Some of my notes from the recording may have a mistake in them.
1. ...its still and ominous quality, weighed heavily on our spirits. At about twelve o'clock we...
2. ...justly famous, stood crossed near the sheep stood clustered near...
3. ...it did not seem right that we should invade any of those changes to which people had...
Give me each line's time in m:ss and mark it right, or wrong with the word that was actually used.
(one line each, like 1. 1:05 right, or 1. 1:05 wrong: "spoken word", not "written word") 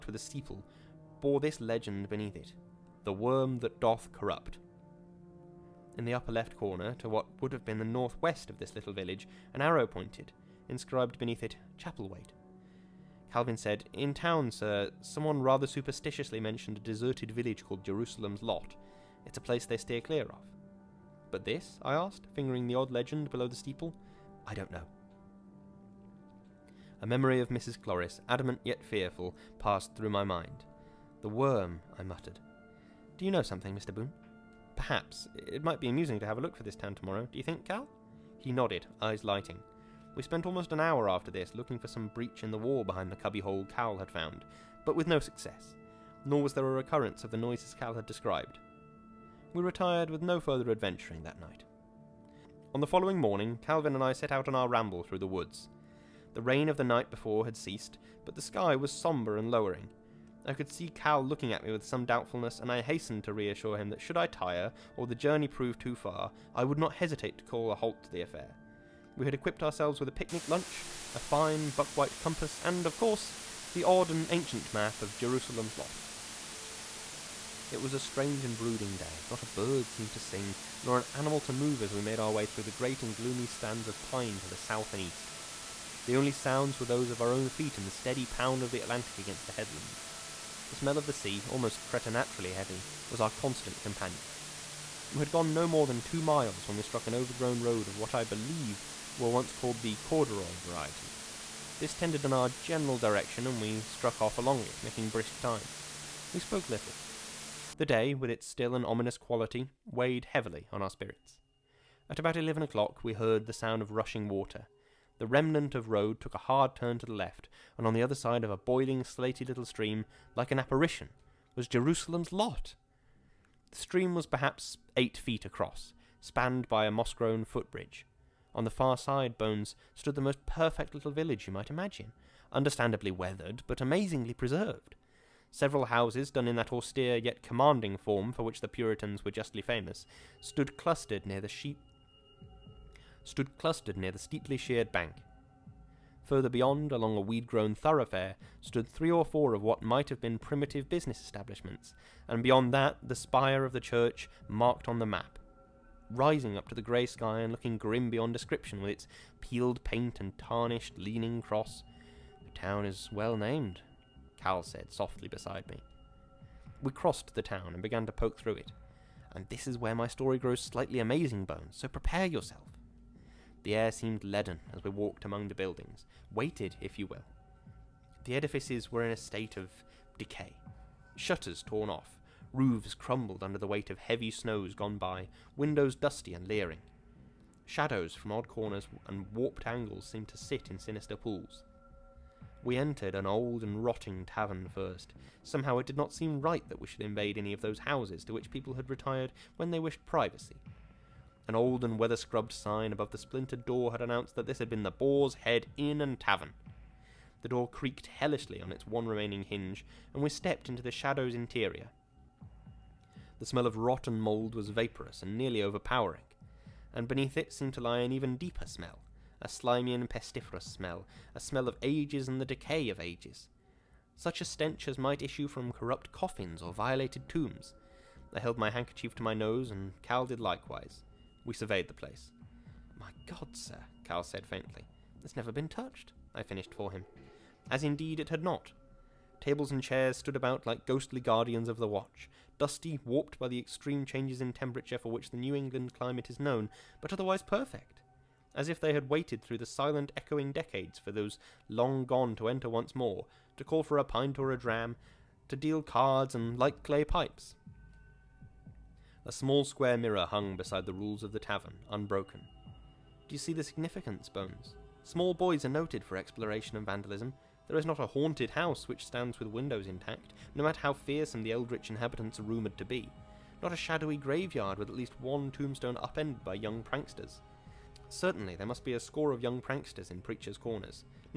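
1. 1:48 wrong: "eleven", not "twelve"
2. 2:19 wrong: "clustered", not "crossed"
3. 3:15 wrong: "houses", not "changes".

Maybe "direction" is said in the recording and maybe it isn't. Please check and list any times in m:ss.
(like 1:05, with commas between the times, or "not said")
1:42.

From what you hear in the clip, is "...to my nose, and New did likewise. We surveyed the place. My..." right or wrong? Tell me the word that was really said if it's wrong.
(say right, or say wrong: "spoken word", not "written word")
wrong: "Cal", not "New".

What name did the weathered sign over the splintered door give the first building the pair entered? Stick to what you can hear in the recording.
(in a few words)
Boar's Head Inn and Tavern.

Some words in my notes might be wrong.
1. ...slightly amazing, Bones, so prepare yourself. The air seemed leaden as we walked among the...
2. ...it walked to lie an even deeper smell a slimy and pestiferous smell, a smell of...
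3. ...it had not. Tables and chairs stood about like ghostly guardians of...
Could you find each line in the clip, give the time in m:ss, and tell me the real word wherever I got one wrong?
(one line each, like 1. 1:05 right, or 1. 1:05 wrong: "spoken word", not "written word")
1. 2:50 right
2. 3:37 wrong: "seemed", not "walked"
3. 3:58 right.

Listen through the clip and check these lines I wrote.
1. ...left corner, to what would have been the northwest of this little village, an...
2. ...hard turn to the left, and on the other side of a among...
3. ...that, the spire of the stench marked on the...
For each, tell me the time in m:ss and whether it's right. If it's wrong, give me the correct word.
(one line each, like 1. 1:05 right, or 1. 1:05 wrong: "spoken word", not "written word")
1. 0:06 right
2. 1:56 wrong: "boiling", not "among"
3. 2:32 wrong: "church", not "stench".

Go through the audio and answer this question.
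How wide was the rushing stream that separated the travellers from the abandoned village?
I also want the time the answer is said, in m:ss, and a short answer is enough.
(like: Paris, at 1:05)
8 feet, at 2:04.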